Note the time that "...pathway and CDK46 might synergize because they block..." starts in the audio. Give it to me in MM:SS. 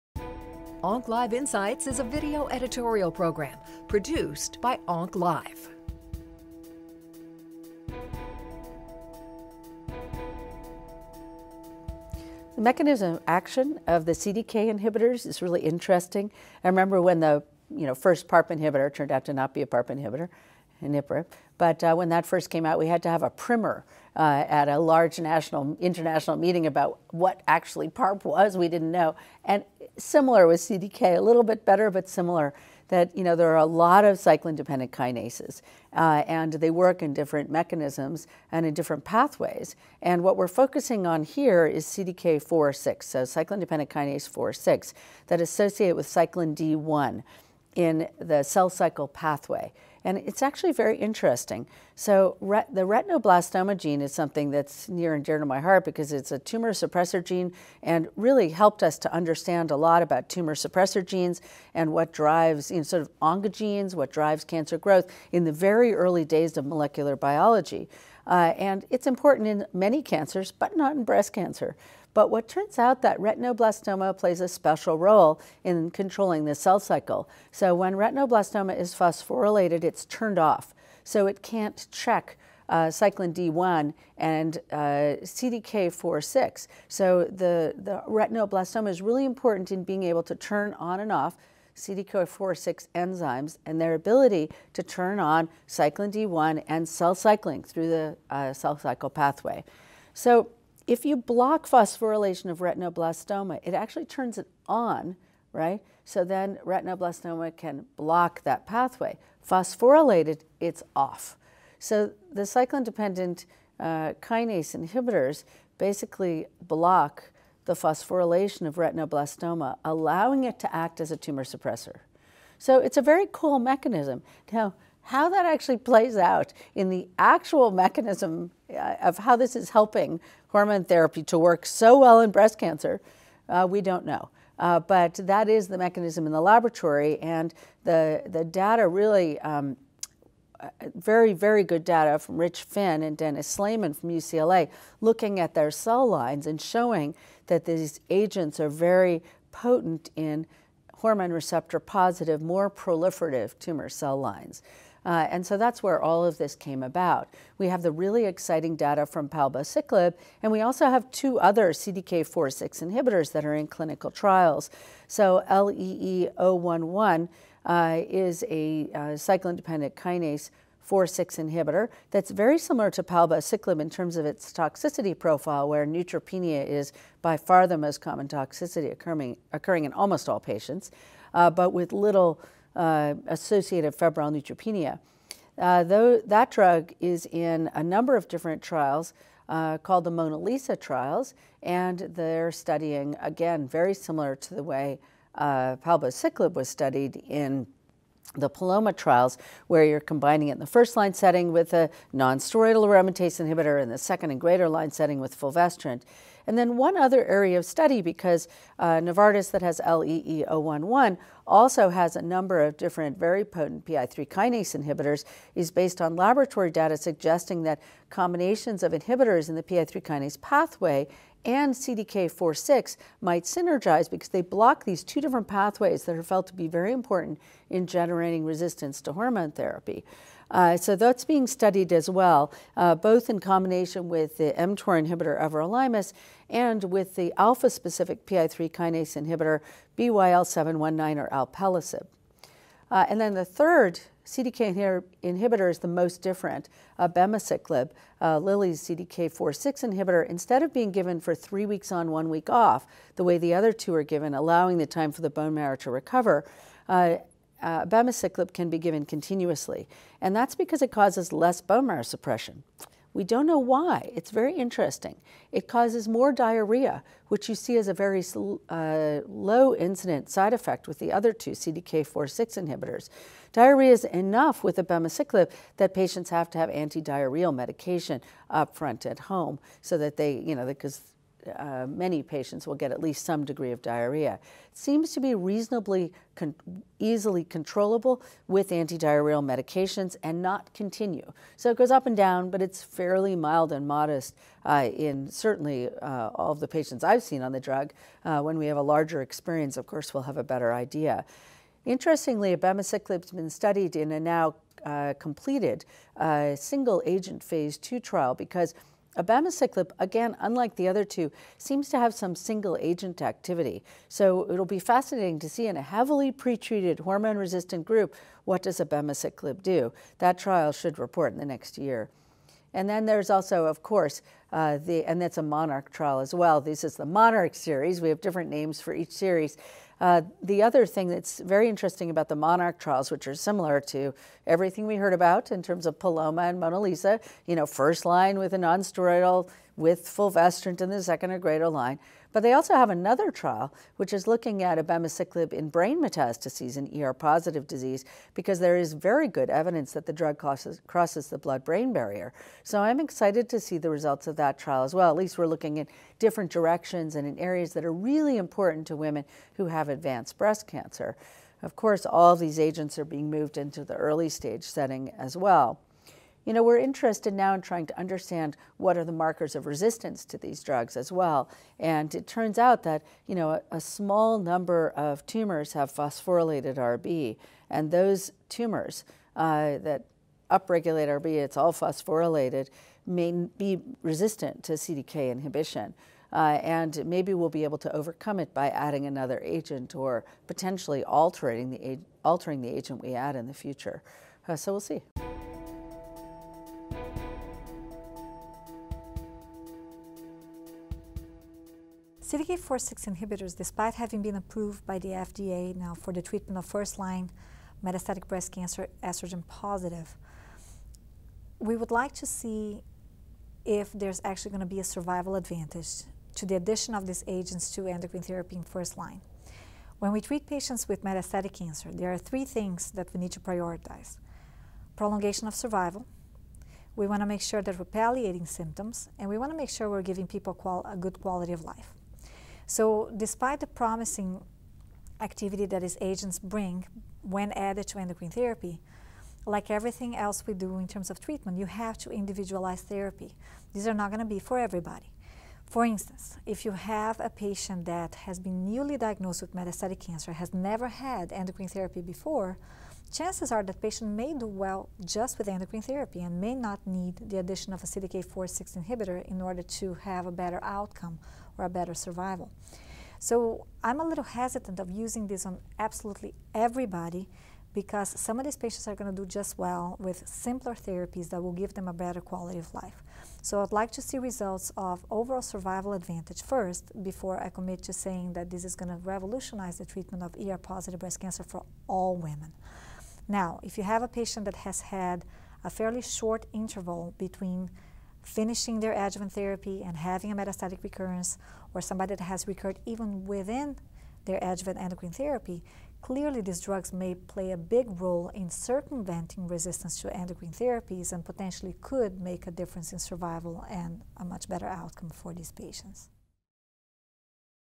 03:40.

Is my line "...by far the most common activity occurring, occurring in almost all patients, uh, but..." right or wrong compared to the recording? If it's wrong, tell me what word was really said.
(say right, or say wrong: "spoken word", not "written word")
wrong: "toxicity", not "activity".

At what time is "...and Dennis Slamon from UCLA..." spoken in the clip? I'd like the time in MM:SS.
02:23.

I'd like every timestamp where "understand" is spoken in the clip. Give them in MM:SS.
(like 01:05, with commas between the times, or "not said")
00:59, 06:07.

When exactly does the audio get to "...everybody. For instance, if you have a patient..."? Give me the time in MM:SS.
07:24.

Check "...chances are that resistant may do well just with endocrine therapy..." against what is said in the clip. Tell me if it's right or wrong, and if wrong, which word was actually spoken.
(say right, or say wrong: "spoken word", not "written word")
wrong: "patient", not "resistant".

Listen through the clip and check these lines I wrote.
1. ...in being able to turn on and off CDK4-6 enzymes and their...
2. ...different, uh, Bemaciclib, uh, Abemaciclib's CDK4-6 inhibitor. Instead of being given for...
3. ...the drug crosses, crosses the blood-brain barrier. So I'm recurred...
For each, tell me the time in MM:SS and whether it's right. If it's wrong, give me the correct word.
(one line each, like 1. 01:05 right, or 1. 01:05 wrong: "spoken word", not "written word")
1. 01:29 right
2. 04:06 wrong: "Lilly", not "Abemaciclib"
3. 05:50 wrong: "excited", not "recurred".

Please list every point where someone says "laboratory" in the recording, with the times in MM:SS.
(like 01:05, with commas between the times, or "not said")
02:16, 03:36.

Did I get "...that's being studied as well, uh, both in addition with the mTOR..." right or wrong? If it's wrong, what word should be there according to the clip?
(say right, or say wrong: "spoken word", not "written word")
wrong: "combination", not "addition".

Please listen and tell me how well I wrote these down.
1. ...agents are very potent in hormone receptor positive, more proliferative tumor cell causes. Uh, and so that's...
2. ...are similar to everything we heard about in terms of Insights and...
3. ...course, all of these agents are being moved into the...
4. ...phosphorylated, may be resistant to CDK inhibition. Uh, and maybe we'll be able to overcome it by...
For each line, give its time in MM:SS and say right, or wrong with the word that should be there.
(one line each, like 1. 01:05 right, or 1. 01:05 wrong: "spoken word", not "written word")
1. 02:28 wrong: "lines", not "causes"
2. 05:33 wrong: "Paloma", not "Insights"
3. 06:01 right
4. 06:21 right.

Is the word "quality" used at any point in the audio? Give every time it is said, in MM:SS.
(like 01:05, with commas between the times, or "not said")
07:11, 07:52.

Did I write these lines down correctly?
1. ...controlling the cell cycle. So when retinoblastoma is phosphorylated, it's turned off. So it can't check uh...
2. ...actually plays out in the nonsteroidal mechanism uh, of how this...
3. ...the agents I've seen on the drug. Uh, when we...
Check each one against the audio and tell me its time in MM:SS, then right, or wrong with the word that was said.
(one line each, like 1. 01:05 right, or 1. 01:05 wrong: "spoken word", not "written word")
1. 01:15 right
2. 02:05 wrong: "actual", not "nonsteroidal"
3. 04:56 wrong: "patients", not "agents".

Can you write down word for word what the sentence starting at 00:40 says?
And what we're focusing on here is CDK4/6, so cyclin-dependent kinase 4/6, that associate with cyclin D1 in the cell cycle pathway.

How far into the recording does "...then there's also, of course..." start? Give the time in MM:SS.
05:22.